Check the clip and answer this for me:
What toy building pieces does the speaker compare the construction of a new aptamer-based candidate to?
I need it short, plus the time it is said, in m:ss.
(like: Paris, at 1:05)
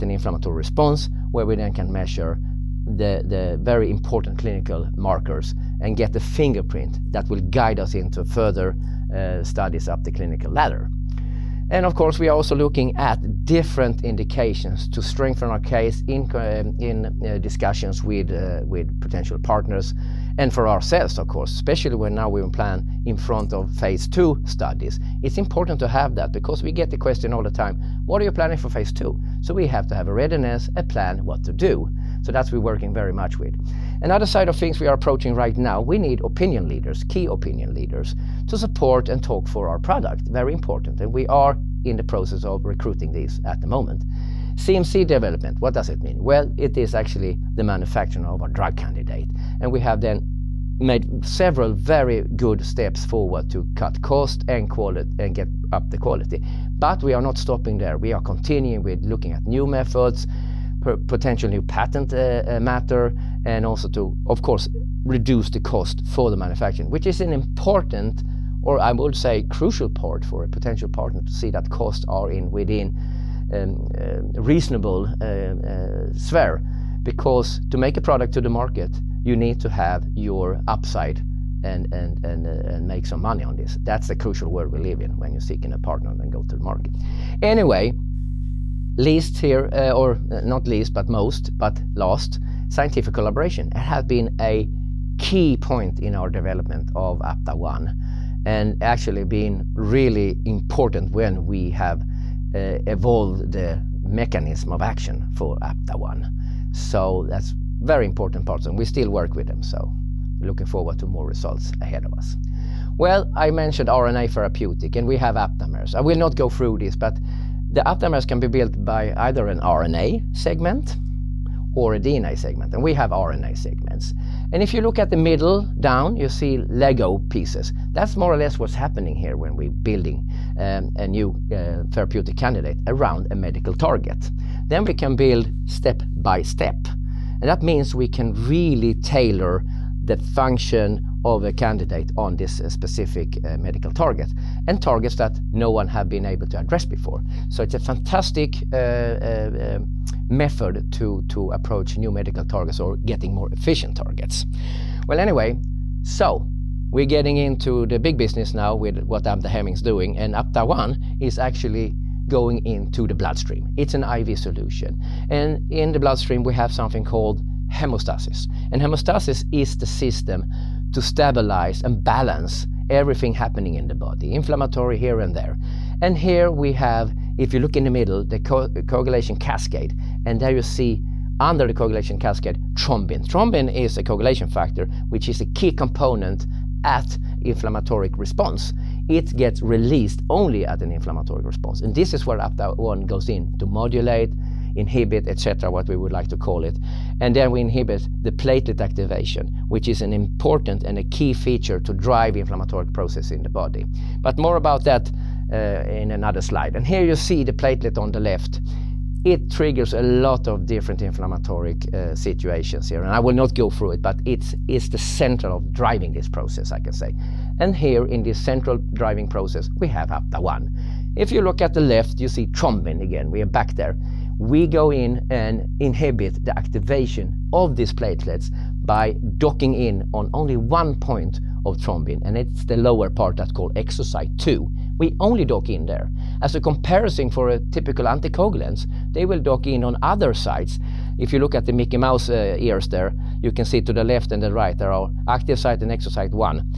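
Lego pieces, at 2:06.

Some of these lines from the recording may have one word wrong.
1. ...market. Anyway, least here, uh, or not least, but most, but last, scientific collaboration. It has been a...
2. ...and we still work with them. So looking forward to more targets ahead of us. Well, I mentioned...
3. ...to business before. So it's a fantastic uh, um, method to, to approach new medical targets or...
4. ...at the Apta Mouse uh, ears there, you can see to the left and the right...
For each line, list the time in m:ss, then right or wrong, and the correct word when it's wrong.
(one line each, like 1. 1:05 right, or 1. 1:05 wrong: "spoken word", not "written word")
1. 1:26 right
2. 1:48 wrong: "results", not "targets"
3. 2:26 wrong: "address", not "business"
4. 4:01 wrong: "Mickey", not "Apta".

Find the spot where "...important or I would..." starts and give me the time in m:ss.
1:07.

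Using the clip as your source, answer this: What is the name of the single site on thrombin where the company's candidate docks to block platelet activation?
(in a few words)
exosite 2.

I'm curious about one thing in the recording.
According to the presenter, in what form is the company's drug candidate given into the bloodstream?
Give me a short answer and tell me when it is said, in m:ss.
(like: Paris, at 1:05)
IV solution, at 2:43.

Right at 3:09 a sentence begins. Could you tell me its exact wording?
It gets released only at an inflammatory response.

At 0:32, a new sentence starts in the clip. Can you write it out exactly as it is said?
So that's we're working very much with.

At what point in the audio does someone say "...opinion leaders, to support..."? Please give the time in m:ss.
0:37.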